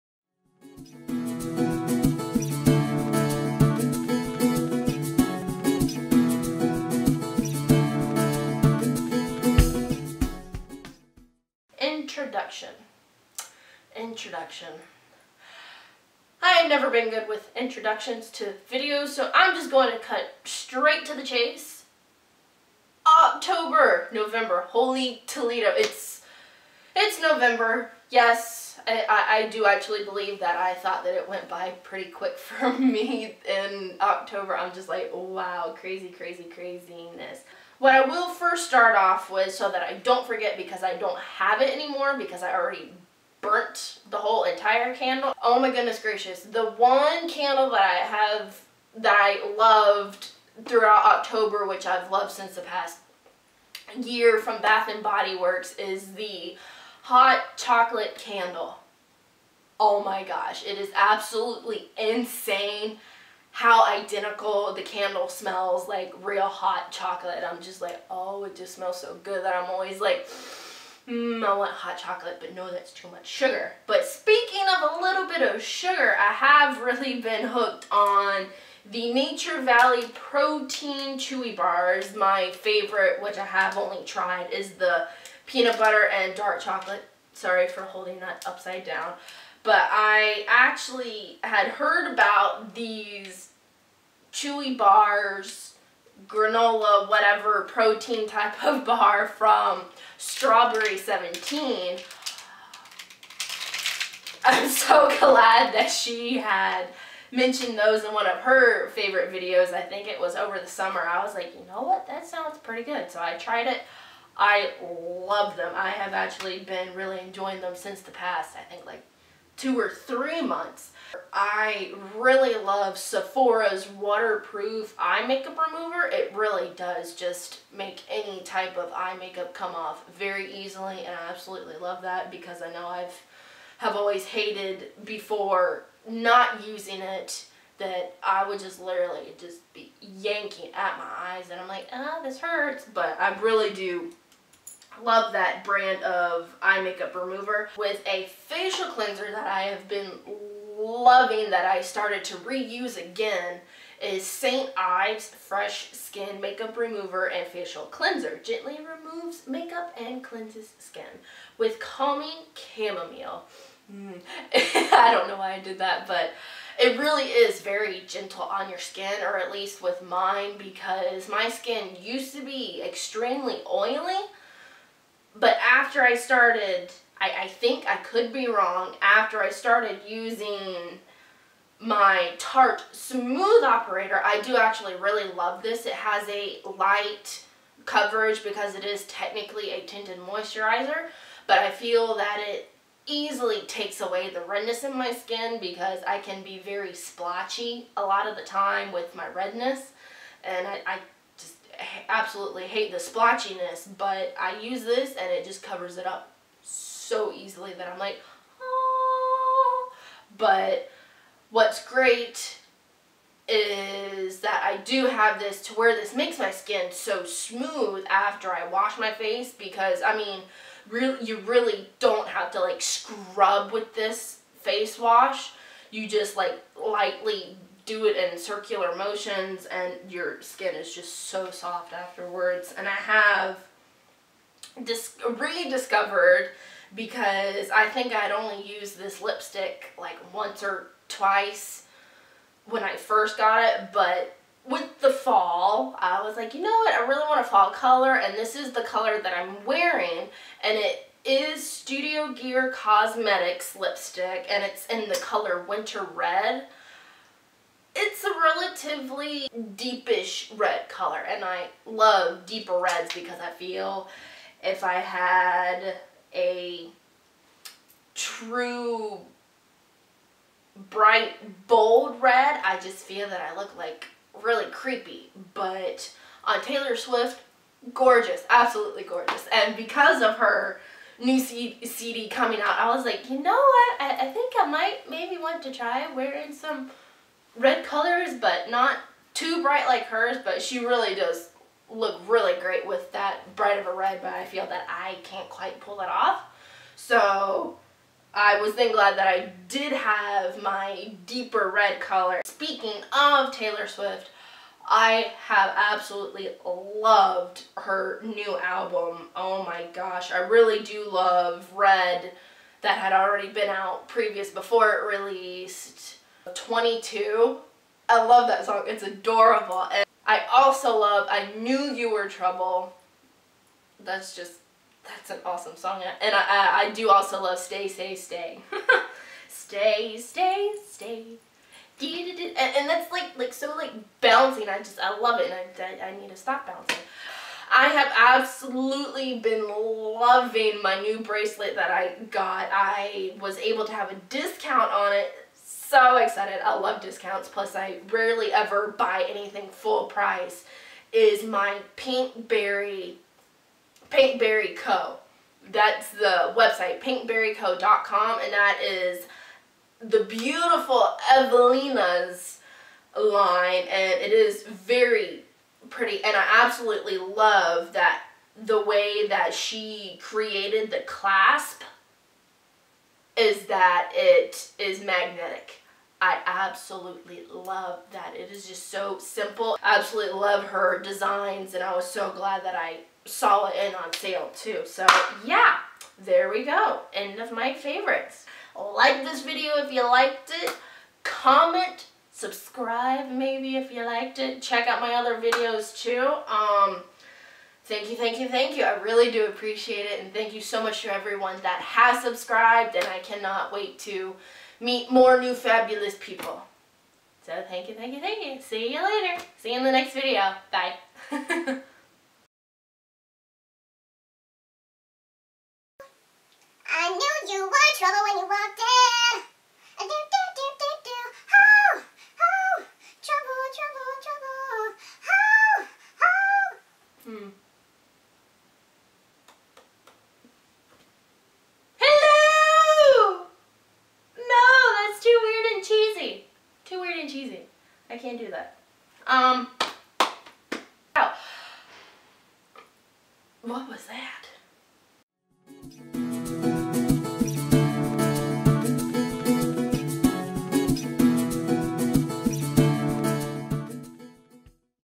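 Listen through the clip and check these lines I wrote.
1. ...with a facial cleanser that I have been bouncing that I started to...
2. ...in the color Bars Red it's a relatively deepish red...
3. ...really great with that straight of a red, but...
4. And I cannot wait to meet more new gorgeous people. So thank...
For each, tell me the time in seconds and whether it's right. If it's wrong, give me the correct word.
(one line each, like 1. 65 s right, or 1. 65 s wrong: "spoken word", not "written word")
1. 147 s wrong: "loving", not "bouncing"
2. 254 s wrong: "Winter", not "Bars"
3. 292 s wrong: "bright", not "straight"
4. 402 s wrong: "fabulous", not "gorgeous".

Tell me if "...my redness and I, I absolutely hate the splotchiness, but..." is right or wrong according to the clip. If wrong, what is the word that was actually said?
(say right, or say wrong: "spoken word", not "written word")
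right.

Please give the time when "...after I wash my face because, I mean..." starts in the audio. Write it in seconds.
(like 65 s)
218 s.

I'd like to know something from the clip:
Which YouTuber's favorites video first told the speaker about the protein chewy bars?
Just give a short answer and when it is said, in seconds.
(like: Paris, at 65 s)
Strawberry 17, at 100 s.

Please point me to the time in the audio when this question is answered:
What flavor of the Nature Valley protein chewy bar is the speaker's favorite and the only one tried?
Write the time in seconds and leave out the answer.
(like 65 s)
85 s.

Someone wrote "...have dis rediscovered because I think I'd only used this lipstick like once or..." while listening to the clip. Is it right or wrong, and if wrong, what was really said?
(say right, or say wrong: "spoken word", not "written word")
right.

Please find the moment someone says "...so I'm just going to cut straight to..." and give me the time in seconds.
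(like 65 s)
19 s.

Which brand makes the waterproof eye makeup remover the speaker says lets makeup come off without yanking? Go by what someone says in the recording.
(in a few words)
Sephora.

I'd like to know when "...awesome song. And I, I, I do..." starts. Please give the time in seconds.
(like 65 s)
325 s.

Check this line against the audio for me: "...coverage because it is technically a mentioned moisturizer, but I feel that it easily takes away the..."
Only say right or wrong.
wrong.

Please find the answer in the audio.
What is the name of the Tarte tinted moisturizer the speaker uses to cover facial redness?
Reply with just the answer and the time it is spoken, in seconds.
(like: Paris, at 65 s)
Smooth Operator, at 182 s.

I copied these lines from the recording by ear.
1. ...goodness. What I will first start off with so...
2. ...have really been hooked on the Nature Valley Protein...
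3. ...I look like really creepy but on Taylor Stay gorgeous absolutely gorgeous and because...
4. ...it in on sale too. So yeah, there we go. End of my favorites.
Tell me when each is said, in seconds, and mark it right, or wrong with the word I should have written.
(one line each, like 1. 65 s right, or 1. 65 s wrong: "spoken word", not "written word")
1. 36 s wrong: "craziness", not "goodness"
2. 76 s right
3. 273 s wrong: "Swift", not "Stay"
4. 383 s right.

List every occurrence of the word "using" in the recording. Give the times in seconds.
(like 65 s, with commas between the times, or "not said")
136 s, 180 s.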